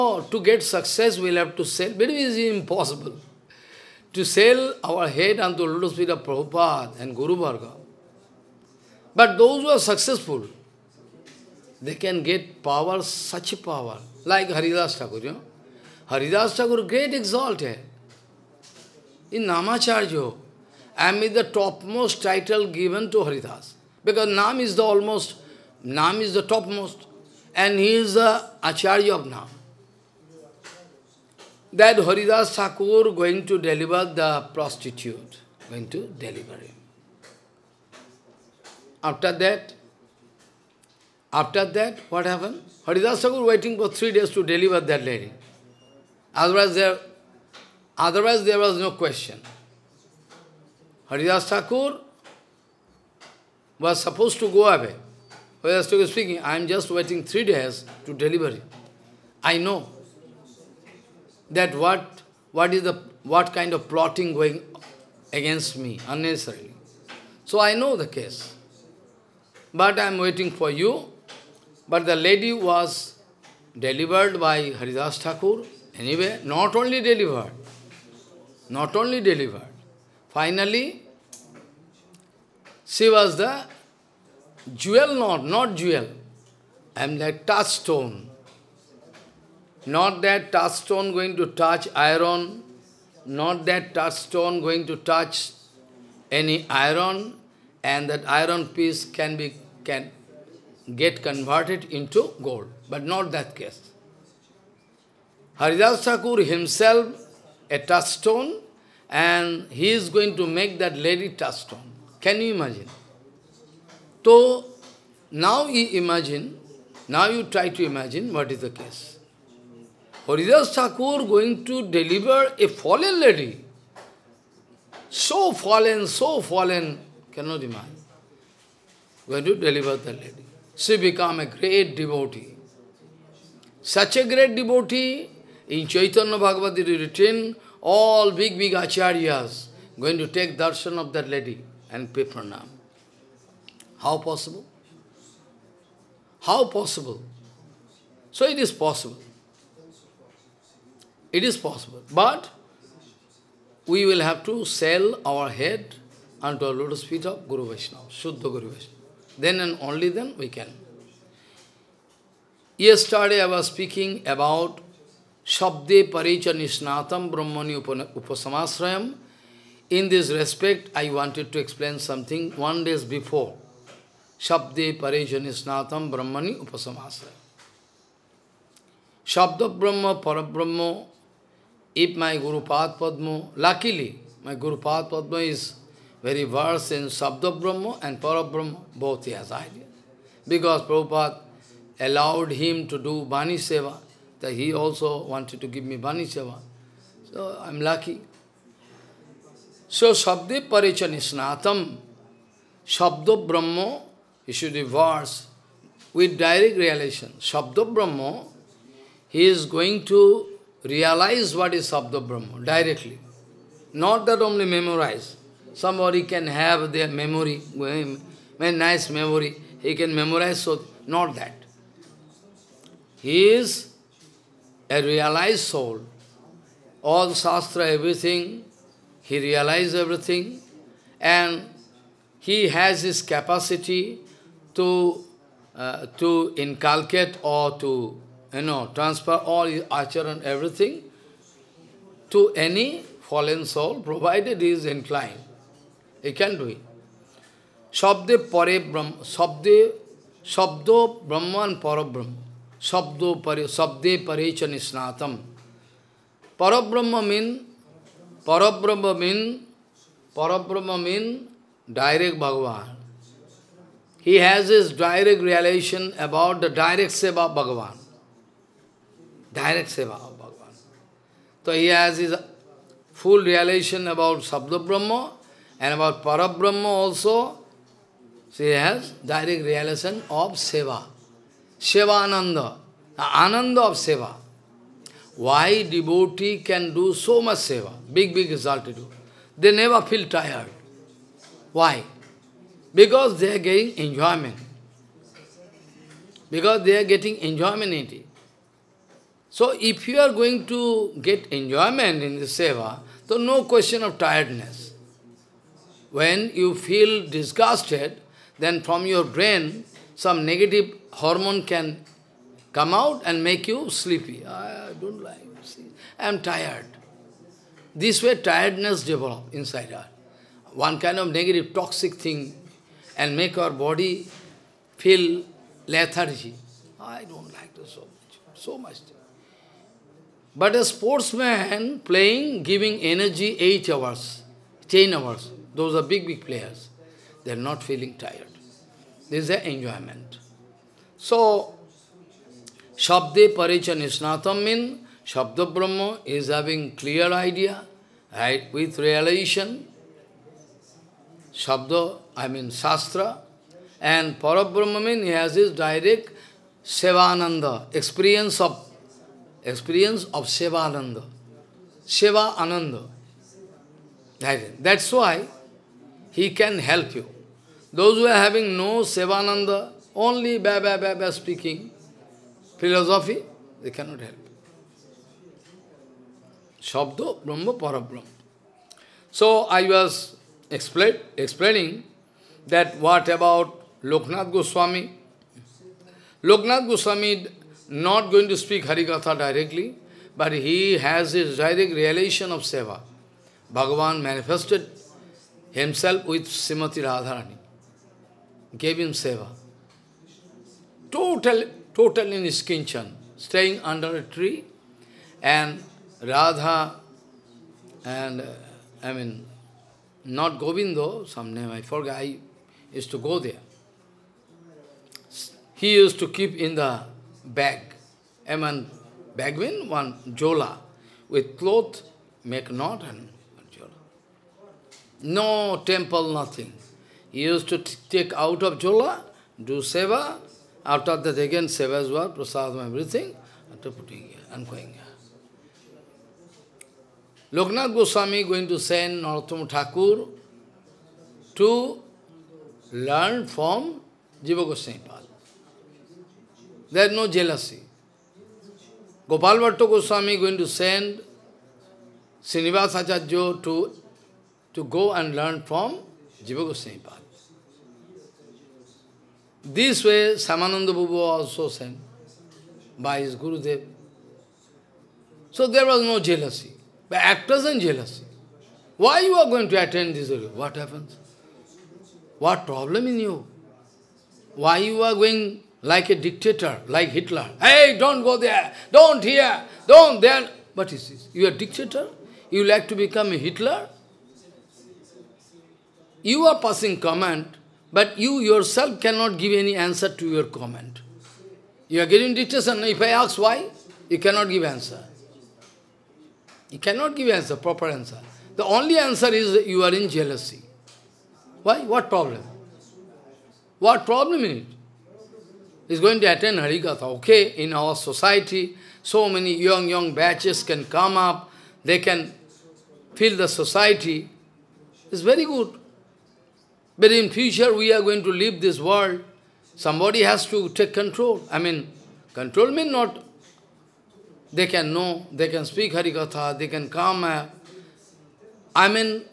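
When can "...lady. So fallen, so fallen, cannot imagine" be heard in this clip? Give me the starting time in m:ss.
2:03.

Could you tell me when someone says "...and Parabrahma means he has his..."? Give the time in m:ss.
5:54.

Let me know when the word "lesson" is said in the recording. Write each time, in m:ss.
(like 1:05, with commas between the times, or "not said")
not said.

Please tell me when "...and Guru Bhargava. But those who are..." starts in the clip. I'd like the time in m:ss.
0:07.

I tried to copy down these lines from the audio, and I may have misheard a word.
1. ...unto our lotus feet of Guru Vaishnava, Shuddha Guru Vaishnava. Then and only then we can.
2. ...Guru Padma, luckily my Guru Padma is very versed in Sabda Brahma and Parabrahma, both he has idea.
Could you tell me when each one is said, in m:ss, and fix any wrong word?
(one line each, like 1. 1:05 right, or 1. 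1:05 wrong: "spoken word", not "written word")
1. 2:36 right
2. 3:02 right.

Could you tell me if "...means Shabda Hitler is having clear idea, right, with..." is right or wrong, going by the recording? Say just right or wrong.
wrong.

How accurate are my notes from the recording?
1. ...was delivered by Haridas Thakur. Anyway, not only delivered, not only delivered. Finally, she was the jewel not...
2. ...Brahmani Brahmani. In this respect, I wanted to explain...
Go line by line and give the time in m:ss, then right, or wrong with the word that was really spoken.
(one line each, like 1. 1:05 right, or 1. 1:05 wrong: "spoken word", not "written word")
1. 1:12 right
2. 2:47 wrong: "Upasamasrayam", not "Brahmani".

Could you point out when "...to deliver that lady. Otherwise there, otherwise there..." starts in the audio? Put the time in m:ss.
0:44.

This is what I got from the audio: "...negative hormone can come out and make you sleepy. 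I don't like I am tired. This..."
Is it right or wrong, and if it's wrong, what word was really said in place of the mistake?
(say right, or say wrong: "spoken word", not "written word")
right.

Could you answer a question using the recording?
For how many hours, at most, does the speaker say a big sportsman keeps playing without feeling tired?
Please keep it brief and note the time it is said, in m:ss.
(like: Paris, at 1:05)
10 hours, at 5:34.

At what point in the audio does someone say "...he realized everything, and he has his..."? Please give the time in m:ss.
3:49.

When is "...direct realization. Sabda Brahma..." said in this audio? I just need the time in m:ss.
3:26.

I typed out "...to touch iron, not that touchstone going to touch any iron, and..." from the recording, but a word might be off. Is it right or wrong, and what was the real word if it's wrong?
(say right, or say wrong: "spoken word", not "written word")
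right.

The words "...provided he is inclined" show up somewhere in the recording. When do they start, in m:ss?
4:04.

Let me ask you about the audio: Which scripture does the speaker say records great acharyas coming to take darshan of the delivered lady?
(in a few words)
Chaitanya Bhagavad Gita.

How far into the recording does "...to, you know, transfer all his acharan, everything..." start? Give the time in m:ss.
3:57.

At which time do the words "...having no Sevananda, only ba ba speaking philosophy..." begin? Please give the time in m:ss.
6:08.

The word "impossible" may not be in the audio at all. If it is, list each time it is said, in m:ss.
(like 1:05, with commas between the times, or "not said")
0:02.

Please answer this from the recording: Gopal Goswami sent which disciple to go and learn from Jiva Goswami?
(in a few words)
Srinivas Acharya.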